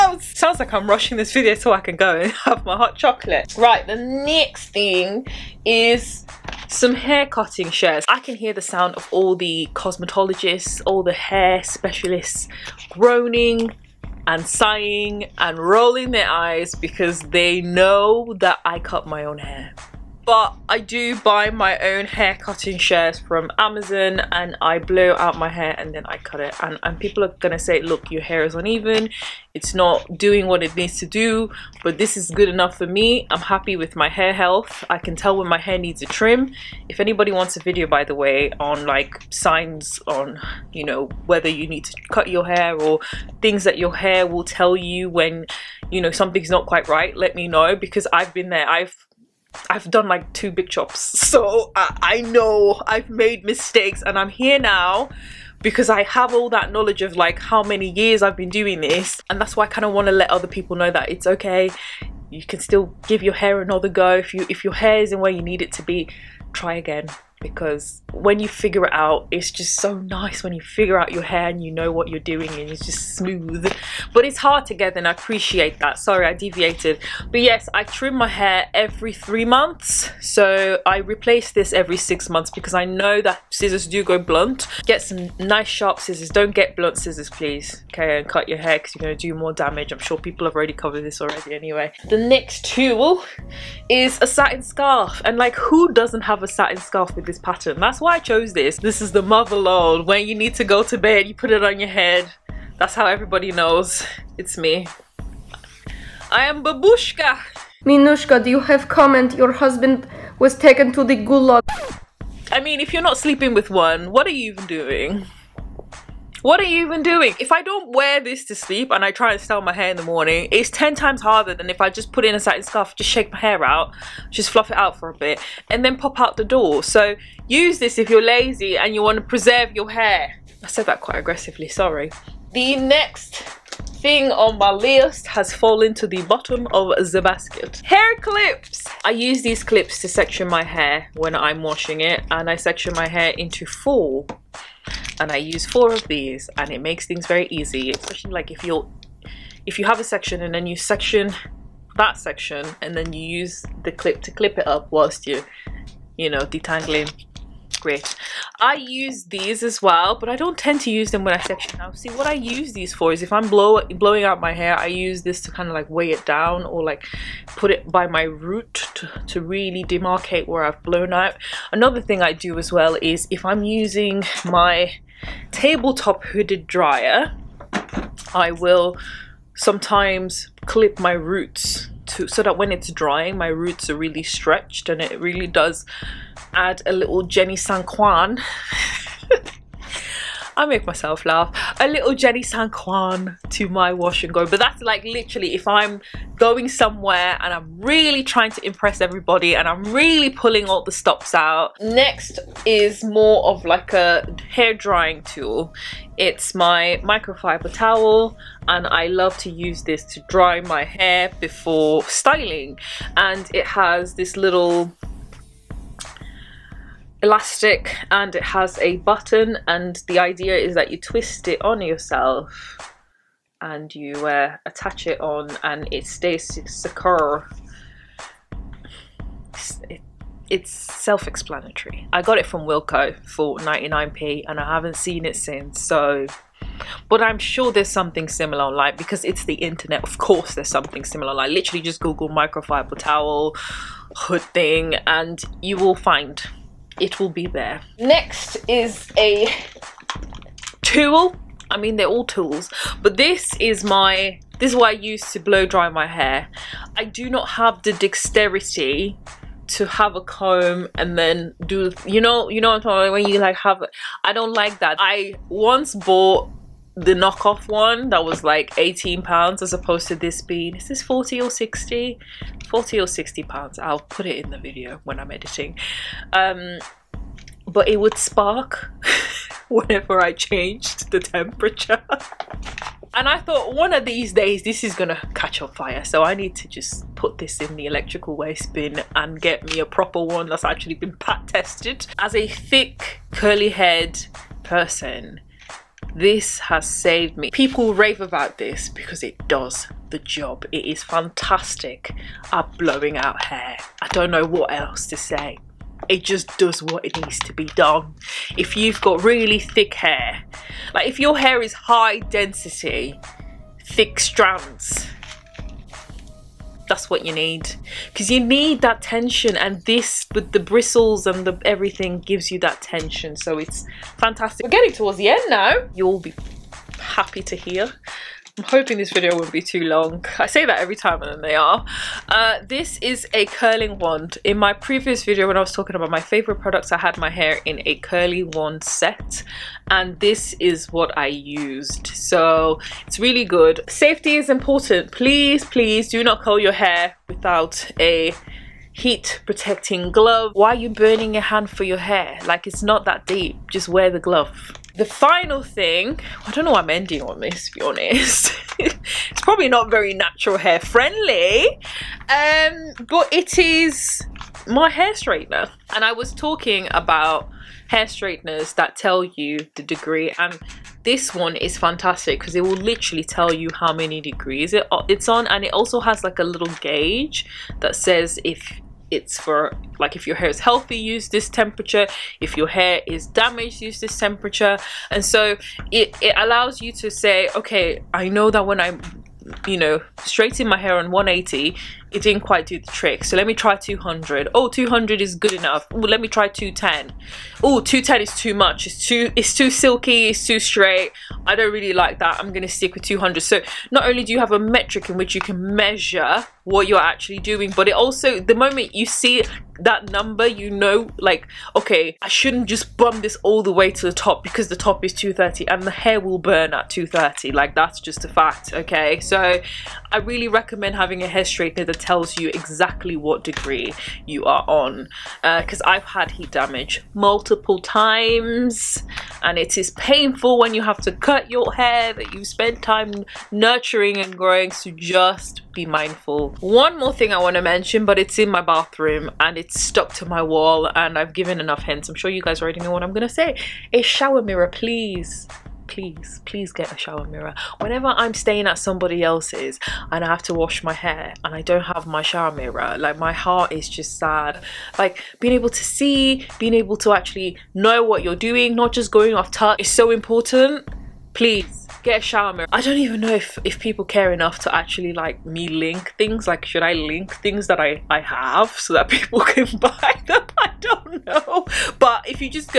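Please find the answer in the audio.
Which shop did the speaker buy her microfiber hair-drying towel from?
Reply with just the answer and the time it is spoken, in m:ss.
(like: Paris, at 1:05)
Wilko, at 3:52.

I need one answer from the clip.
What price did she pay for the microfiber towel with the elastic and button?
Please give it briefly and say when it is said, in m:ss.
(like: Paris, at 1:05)
99p, at 3:53.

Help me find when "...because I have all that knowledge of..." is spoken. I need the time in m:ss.
0:55.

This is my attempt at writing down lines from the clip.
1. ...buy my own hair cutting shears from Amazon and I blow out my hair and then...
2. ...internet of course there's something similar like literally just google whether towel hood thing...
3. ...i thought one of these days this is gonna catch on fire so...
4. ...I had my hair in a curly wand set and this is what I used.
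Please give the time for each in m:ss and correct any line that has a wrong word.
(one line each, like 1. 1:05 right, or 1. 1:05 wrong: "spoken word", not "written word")
1. 0:21 right
2. 3:59 wrong: "microfiber", not "whether"
3. 4:43 right
4. 5:36 right.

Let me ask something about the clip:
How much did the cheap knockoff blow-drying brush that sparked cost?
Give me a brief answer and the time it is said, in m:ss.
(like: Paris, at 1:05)
18 pounds, at 4:28.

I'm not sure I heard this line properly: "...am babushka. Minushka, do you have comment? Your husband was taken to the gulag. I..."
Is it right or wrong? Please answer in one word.
right.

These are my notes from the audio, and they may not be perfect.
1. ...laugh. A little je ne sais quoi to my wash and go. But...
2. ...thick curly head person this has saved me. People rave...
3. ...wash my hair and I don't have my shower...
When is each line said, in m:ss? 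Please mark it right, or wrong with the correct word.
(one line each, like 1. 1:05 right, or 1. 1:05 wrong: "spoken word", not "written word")
1. 3:11 right
2. 4:52 right
3. 7:30 right.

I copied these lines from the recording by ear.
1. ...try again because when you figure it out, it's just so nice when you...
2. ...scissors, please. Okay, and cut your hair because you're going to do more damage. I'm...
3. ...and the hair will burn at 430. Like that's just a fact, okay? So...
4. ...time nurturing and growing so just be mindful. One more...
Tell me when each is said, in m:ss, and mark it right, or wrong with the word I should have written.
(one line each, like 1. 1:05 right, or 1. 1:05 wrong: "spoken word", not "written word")
1. 1:06 right
2. 1:26 right
3. 6:55 wrong: "230", not "430"
4. 7:12 right.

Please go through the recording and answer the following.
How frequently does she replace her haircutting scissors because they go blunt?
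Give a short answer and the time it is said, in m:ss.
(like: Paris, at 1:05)
every 6 months, at 1:21.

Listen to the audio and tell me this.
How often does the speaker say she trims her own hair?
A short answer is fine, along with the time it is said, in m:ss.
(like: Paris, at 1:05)
every 3 months, at 1:18.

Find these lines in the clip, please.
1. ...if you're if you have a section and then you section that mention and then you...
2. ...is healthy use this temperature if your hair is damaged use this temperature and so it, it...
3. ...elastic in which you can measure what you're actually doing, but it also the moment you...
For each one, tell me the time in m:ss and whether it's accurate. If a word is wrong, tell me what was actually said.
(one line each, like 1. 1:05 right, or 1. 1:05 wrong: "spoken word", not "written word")
1. 2:28 wrong: "section", not "mention"
2. 6:20 right
3. 6:44 wrong: "metric", not "elastic".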